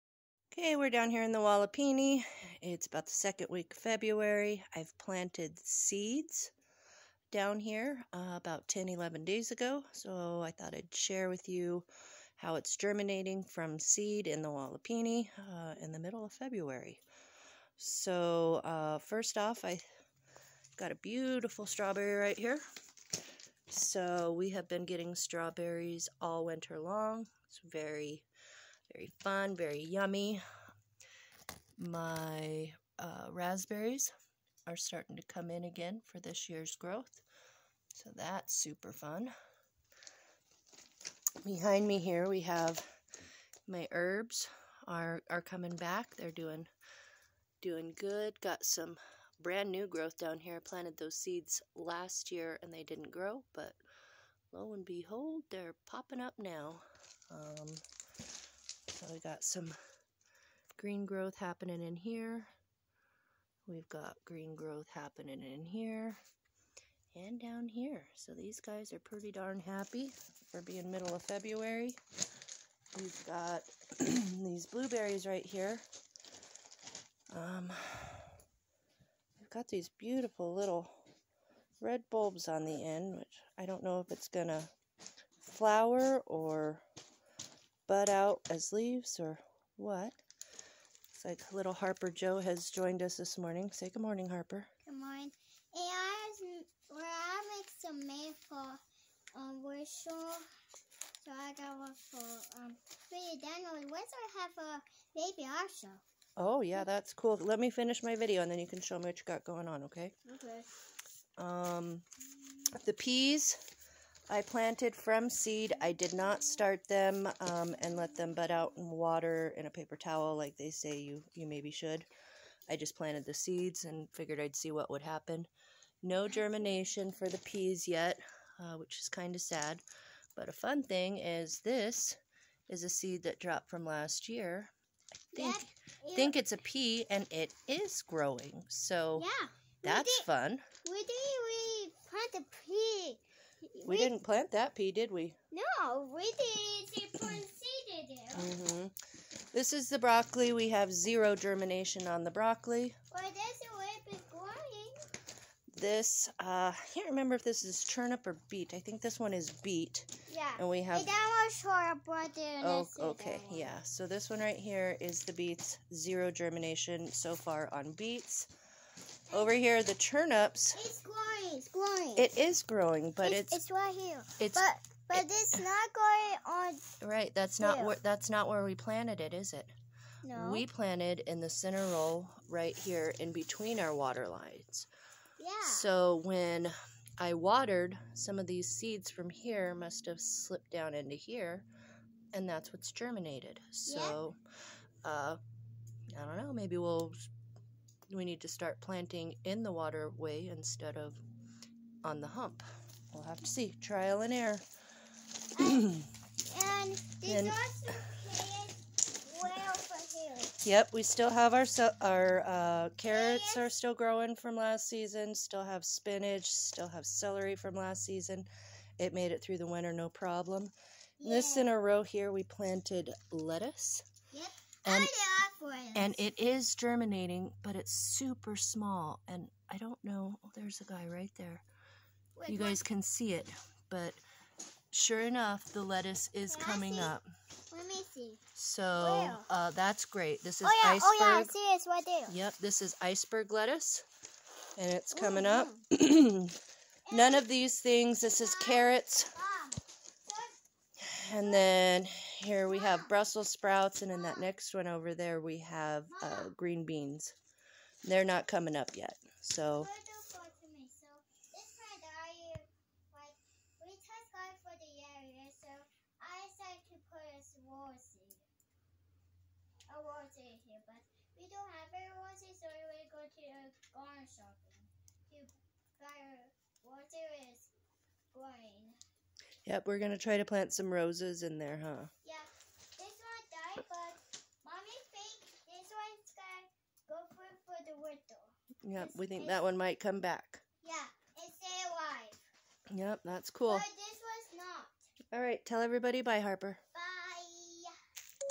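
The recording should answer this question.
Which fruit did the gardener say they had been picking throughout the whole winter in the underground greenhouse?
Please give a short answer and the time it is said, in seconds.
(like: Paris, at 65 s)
Strawberries, at 25 s.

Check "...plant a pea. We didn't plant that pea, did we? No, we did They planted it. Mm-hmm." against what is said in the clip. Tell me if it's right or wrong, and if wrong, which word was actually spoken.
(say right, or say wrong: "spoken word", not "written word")
right.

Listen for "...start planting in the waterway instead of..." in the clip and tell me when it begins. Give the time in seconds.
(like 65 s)
198 s.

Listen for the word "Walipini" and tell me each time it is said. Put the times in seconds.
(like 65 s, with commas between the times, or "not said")
1 s, 14 s.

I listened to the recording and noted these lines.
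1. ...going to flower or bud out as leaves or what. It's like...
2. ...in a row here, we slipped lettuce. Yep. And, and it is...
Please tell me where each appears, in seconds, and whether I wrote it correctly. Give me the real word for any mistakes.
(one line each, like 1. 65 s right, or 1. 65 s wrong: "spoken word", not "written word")
1. 84 s right
2. 221 s wrong: "planted", not "slipped".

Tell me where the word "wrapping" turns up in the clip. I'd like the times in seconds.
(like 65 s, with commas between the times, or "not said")
not said.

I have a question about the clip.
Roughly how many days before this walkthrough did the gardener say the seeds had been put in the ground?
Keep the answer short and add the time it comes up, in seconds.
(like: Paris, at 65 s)
10 to 11 days, at 8 s.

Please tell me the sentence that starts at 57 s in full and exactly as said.
Um, so we got some green growth happening in here.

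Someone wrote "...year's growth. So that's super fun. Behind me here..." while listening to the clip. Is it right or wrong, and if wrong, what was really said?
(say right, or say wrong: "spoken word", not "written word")
right.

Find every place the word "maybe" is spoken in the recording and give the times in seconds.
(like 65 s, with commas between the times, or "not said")
121 s, 196 s.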